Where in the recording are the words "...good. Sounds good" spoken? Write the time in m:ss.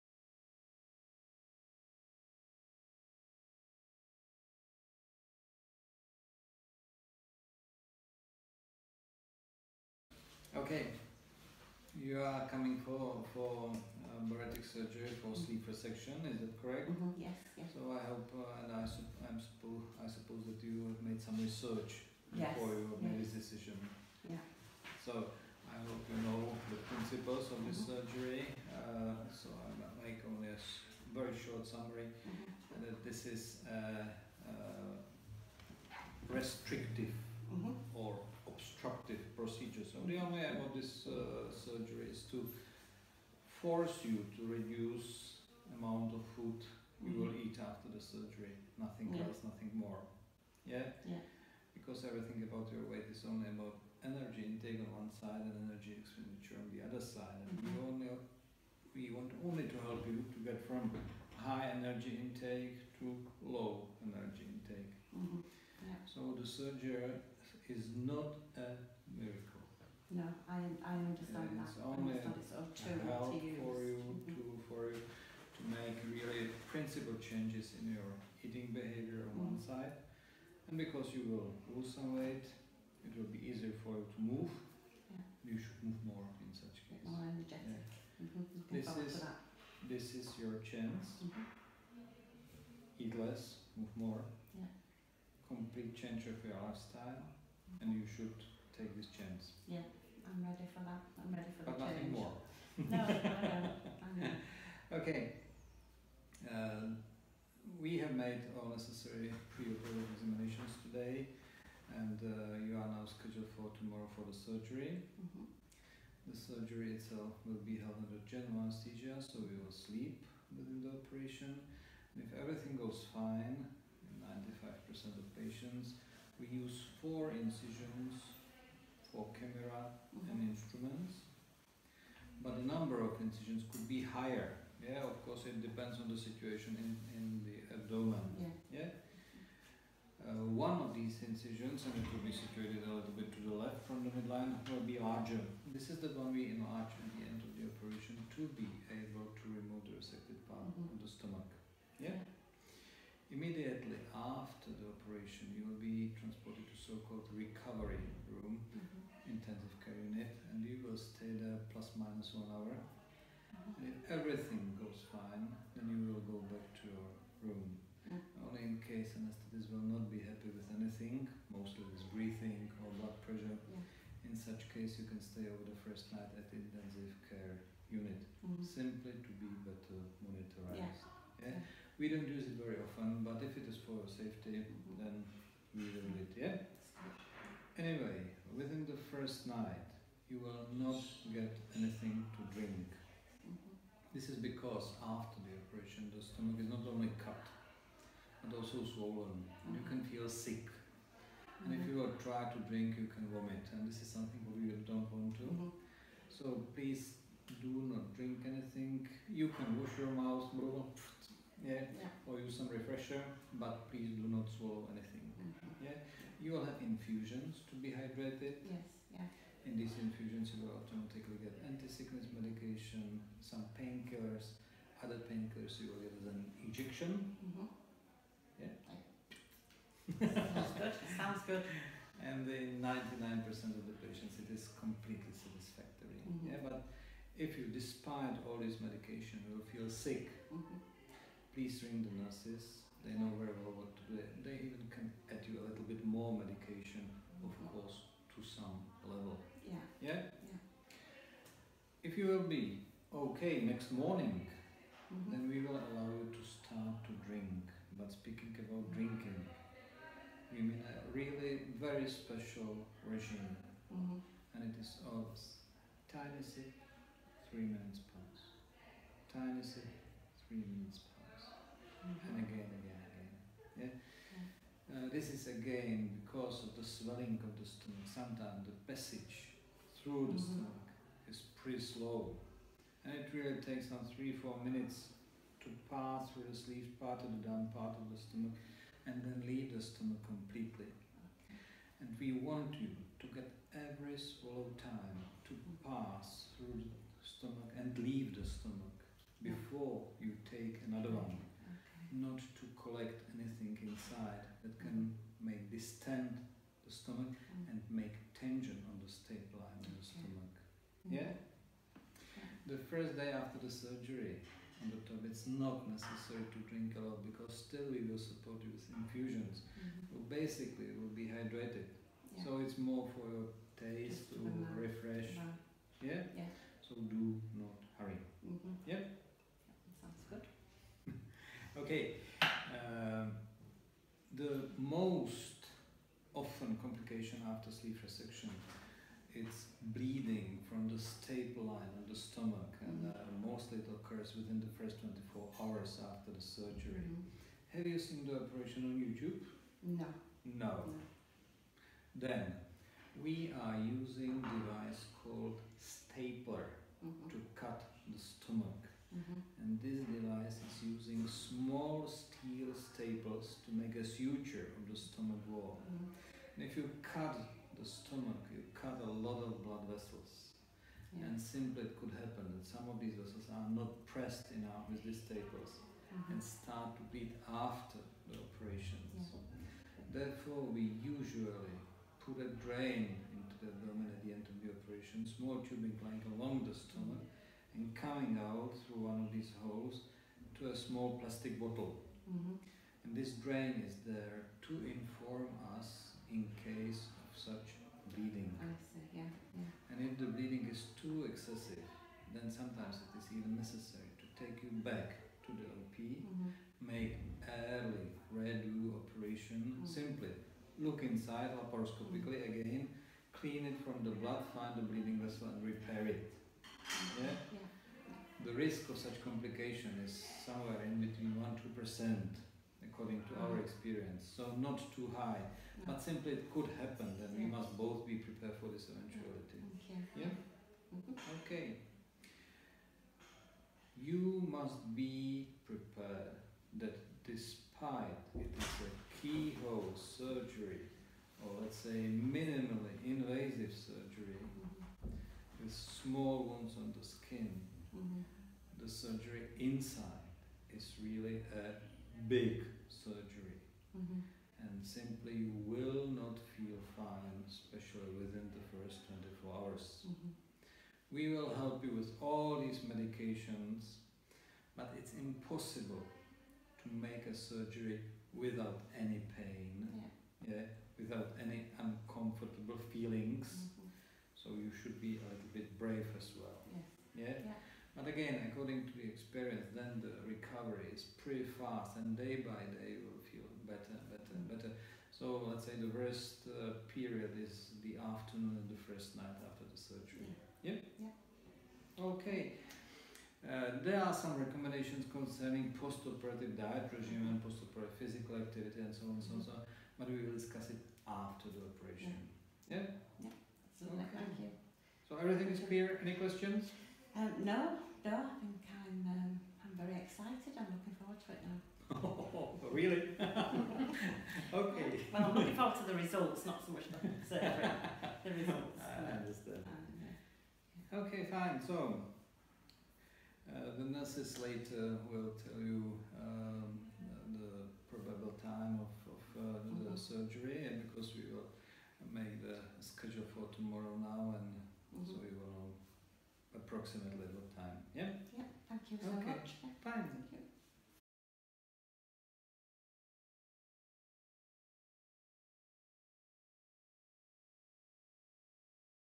3:50.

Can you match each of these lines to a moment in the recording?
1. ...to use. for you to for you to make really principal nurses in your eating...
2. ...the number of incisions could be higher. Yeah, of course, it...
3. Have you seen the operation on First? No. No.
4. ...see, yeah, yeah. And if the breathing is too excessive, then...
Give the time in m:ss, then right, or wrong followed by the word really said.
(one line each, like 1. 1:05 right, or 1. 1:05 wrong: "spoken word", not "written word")
1. 1:13 wrong: "changes", not "nurses"
2. 2:12 right
3. 5:47 wrong: "YouTube", not "First"
4. 6:38 wrong: "bleeding", not "breathing".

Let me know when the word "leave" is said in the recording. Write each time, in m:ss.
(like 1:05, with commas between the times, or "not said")
4:49, 4:58.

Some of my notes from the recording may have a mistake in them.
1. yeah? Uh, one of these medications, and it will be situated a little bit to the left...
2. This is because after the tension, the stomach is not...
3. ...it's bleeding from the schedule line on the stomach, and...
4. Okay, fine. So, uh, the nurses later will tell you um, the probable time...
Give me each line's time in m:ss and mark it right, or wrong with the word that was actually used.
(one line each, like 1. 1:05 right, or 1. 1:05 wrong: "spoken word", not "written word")
1. 2:18 wrong: "incisions", not "medications"
2. 3:14 wrong: "operation", not "tension"
3. 5:39 wrong: "staple", not "schedule"
4. 8:40 right.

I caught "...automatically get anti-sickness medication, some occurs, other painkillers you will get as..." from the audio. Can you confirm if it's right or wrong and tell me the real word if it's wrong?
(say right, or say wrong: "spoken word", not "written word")
wrong: "painkillers", not "occurs".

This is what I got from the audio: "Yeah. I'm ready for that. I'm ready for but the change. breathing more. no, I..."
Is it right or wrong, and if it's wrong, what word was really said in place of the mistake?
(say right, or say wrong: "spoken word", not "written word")
wrong: "nothing", not "breathing".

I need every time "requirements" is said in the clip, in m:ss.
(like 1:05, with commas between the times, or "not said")
not said.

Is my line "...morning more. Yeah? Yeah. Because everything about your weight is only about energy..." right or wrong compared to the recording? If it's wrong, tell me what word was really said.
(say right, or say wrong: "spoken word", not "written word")
wrong: "nothing", not "morning".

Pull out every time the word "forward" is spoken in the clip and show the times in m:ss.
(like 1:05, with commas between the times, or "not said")
8:30, 8:35.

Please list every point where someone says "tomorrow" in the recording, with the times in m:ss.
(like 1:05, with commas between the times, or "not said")
1:53, 8:53.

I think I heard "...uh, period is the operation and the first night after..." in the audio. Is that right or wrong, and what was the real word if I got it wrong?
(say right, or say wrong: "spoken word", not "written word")
wrong: "afternoon", not "operation".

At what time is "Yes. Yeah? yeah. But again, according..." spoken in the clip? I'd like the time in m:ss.
7:57.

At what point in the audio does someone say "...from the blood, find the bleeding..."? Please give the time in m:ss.
6:53.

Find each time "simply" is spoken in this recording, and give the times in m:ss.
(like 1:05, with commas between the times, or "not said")
2:58, 6:11, 6:49, 7:06, 7:34.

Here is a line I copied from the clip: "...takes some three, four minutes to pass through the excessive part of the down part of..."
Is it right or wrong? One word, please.
wrong.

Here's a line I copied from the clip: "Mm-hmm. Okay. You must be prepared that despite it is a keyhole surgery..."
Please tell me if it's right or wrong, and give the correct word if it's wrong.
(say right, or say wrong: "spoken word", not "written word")
right.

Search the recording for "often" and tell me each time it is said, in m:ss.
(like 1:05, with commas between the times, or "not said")
3:02.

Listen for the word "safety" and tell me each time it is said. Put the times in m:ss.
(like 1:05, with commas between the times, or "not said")
3:04.